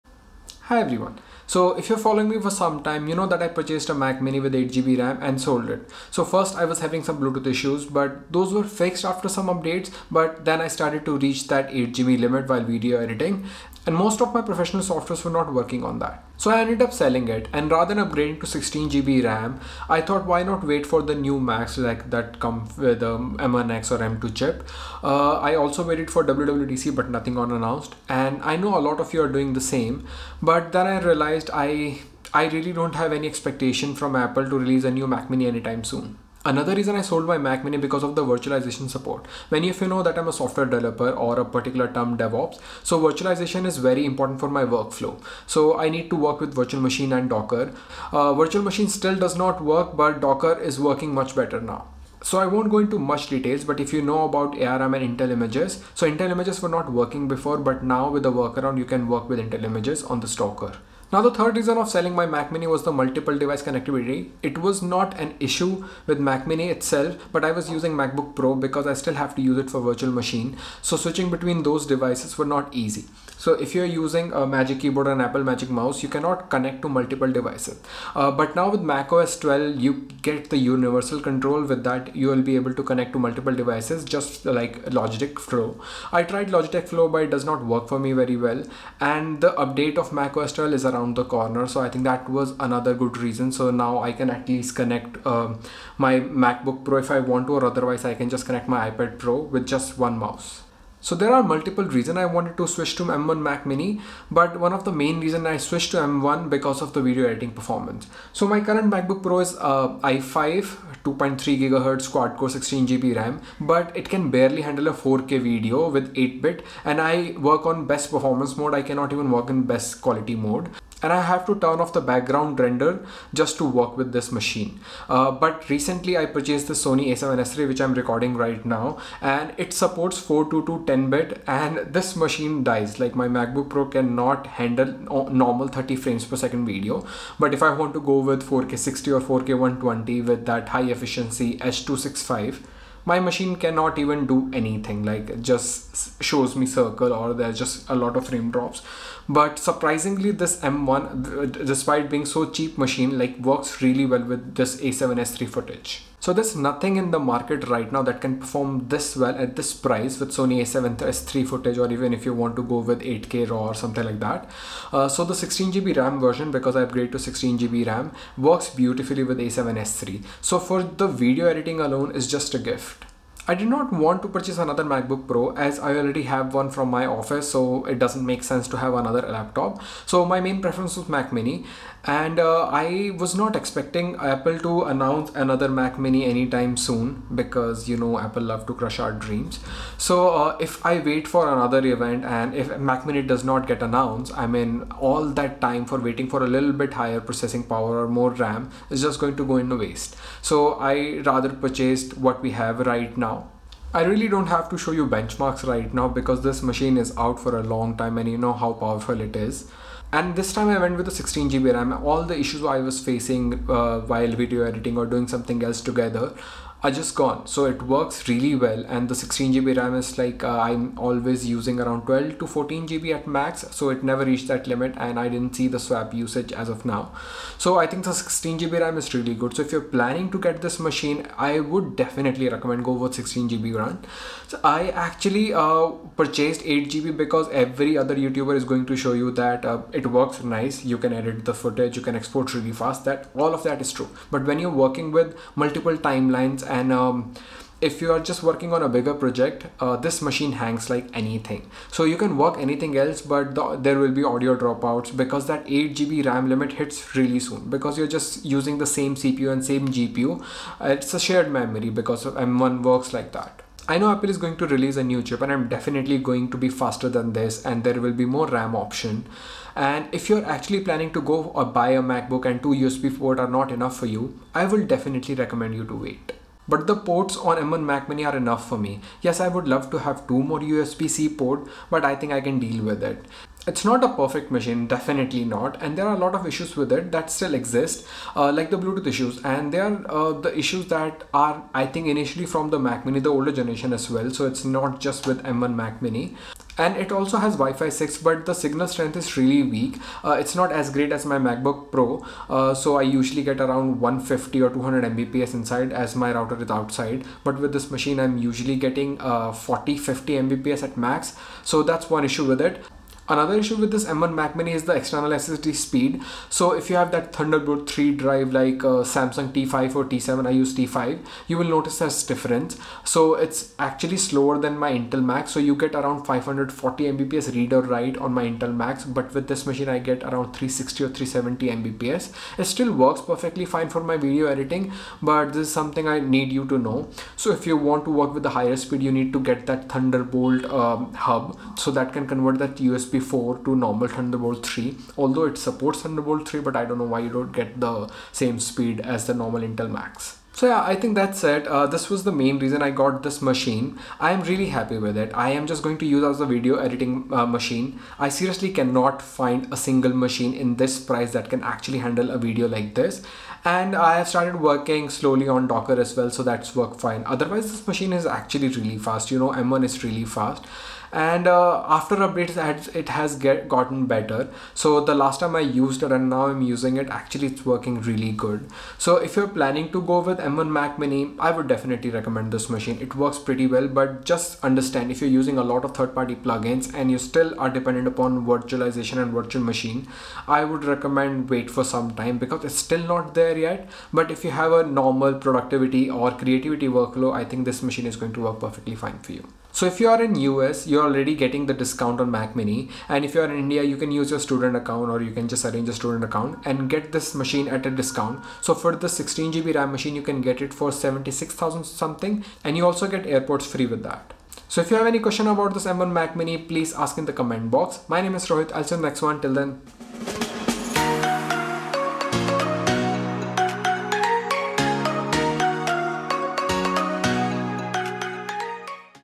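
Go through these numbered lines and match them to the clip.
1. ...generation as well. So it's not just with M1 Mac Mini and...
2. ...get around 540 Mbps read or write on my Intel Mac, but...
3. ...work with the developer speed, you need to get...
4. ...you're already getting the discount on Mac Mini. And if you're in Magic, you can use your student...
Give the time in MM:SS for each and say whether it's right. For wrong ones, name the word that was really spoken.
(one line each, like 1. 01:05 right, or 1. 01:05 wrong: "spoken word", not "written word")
1. 04:53 right
2. 05:25 right
3. 05:38 wrong: "higher", not "developer"
4. 06:40 wrong: "India", not "Magic".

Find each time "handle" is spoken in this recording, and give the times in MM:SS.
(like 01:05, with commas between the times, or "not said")
01:54, 02:14, 06:01.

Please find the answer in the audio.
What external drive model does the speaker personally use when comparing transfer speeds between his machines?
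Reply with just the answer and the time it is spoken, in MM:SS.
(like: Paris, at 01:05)
Samsung T5, at 05:20.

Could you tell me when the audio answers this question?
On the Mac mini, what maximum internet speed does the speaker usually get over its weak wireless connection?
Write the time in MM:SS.
05:09.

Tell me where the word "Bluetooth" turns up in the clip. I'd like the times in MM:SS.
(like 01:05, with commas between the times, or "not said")
00:07, 04:48.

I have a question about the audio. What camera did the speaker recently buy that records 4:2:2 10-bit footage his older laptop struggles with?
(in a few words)
Sony a7S 3.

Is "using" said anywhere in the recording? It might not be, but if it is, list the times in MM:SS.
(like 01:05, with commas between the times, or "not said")
01:07, 01:13, 03:41, 04:18, 06:16, 06:25.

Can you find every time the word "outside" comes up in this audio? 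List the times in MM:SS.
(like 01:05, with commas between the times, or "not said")
05:06.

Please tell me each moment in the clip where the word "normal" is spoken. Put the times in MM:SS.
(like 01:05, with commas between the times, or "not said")
02:15, 05:43, 05:49, 06:34.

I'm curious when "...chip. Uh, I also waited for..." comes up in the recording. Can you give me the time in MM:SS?
00:24.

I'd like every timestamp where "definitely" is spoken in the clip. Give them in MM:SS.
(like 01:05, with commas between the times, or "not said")
03:51, 04:25, 04:34, 04:44, 06:21.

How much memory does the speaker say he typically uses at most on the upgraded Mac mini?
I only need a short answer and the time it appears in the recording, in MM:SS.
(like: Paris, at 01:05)
12 to 14 GB, at 03:42.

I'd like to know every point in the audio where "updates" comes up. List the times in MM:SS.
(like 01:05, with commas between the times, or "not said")
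00:09, 01:29, 06:12.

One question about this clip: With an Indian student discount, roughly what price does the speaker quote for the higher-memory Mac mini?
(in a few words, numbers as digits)
76,000.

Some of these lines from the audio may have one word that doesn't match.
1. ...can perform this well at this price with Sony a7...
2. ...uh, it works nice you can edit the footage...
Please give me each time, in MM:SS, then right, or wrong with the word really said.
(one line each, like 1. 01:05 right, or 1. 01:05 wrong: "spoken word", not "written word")
1. 02:38 right
2. 03:59 right.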